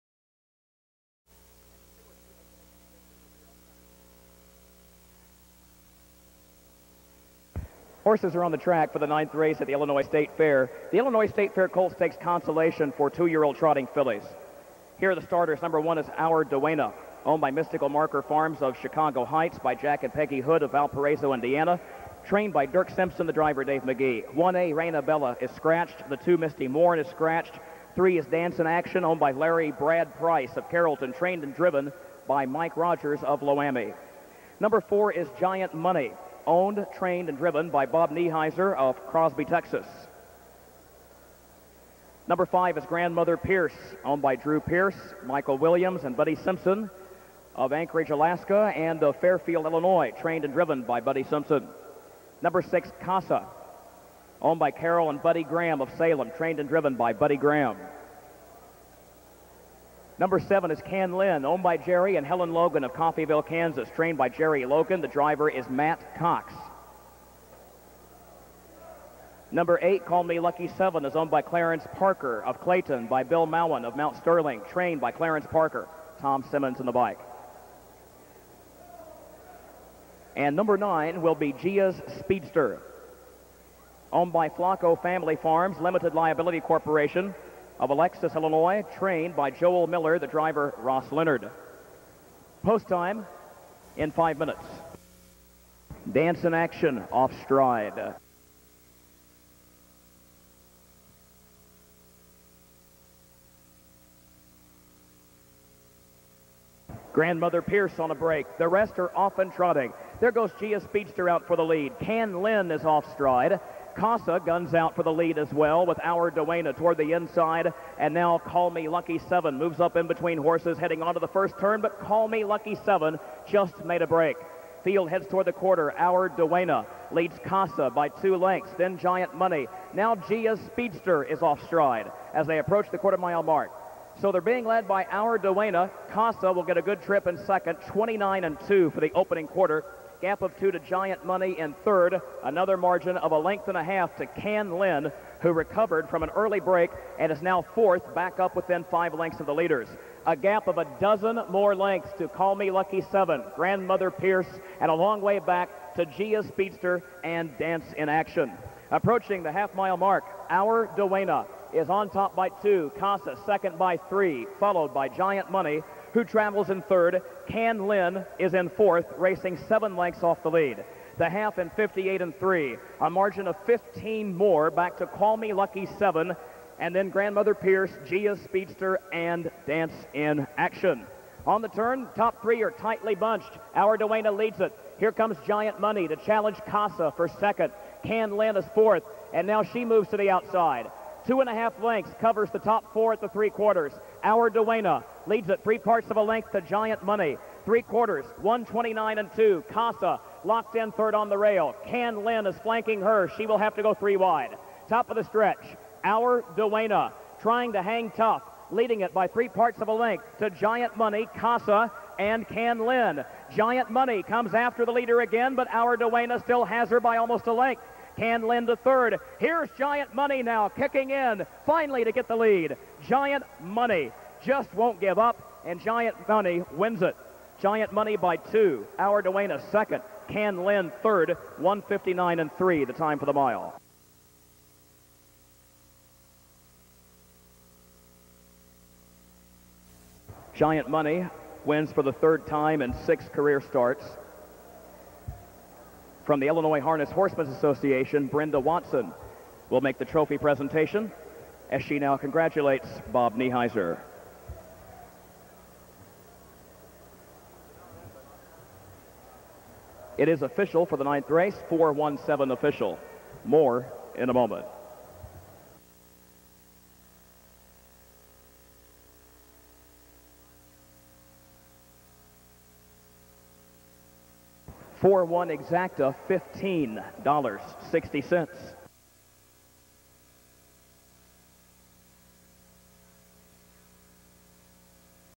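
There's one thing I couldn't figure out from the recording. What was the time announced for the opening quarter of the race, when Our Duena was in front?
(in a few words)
29 and 2.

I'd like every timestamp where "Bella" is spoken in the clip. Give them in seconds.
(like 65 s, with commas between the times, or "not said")
25 s.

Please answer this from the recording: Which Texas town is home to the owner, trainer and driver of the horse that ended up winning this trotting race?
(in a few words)
Crosby.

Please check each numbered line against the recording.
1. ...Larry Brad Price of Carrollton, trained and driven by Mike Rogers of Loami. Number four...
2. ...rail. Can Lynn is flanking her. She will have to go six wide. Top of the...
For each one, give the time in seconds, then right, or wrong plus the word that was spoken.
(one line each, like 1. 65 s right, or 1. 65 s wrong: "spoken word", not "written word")
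1. 29 s right
2. 201 s wrong: "three", not "six".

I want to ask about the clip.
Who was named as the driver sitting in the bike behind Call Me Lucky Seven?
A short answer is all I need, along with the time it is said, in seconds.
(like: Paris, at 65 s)
Tom Simmons, at 76 s.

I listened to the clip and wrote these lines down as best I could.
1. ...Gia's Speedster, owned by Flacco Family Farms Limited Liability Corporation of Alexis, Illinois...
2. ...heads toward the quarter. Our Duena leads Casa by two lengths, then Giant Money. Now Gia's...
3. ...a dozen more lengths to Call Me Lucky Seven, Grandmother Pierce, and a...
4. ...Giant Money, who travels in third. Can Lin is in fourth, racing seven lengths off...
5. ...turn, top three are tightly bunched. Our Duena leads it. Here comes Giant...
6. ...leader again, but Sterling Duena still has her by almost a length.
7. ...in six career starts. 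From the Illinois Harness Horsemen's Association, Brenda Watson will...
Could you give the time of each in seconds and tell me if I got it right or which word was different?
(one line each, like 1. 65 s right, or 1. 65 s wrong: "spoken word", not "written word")
1. 81 s right
2. 125 s right
3. 150 s right
4. 165 s right
5. 181 s right
6. 214 s wrong: "Our", not "Sterling"
7. 242 s right.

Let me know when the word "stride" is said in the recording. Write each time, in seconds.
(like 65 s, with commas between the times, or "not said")
97 s, 113 s, 131 s.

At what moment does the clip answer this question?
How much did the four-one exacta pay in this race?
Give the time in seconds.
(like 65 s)
276 s.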